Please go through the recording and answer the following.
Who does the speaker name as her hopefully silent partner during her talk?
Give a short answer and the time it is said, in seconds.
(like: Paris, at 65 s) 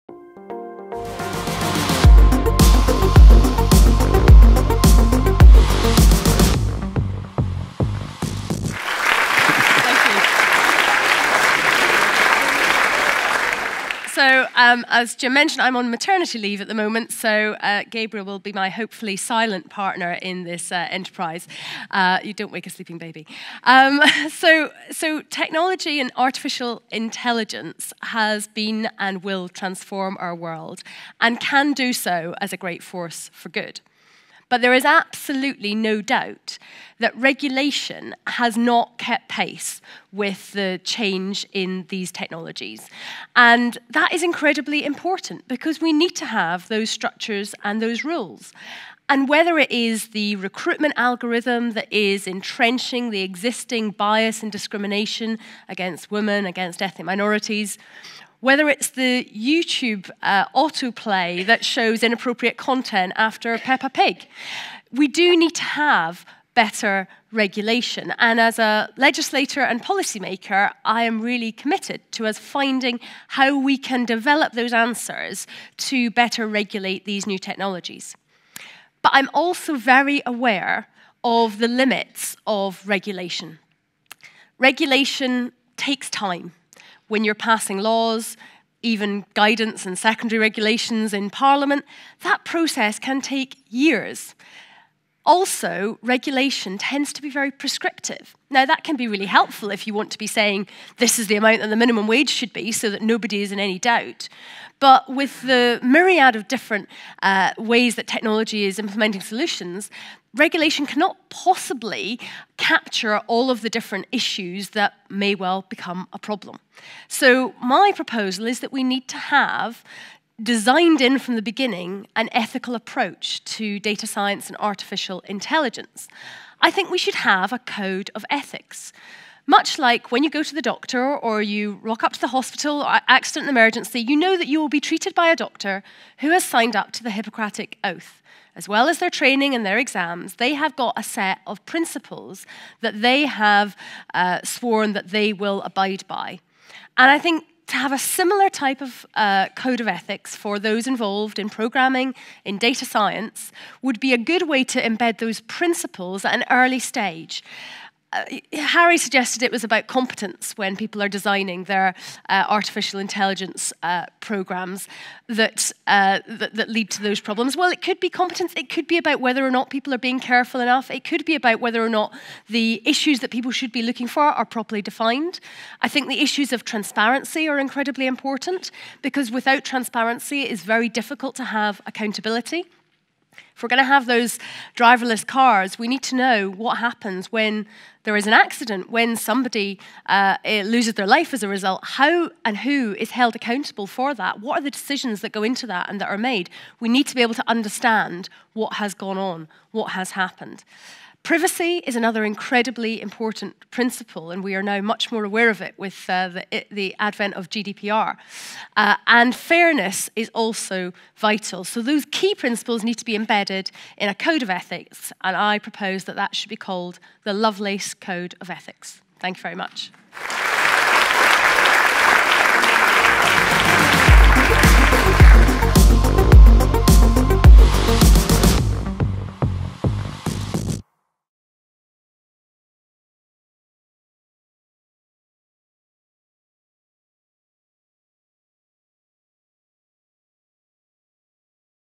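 Gabriel, at 17 s.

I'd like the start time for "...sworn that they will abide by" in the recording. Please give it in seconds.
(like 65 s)
144 s.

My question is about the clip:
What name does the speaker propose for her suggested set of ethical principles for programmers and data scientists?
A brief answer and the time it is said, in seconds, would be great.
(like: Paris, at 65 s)
Lovelace Code of Ethics, at 217 s.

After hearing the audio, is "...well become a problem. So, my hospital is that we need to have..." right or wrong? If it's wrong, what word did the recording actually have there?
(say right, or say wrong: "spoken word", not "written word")
wrong: "proposal", not "hospital".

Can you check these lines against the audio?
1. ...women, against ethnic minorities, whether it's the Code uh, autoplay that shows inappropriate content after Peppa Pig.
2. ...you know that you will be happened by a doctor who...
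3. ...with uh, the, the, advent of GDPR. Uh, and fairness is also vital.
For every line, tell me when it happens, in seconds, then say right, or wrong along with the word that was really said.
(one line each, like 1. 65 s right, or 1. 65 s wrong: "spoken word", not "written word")
1. 56 s wrong: "YouTube", not "Code"
2. 133 s wrong: "treated", not "happened"
3. 205 s right.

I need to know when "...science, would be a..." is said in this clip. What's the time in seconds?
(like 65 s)
152 s.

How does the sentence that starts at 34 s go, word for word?
But there is absolutely no doubt that regulation has not kept pace with the change in these technologies.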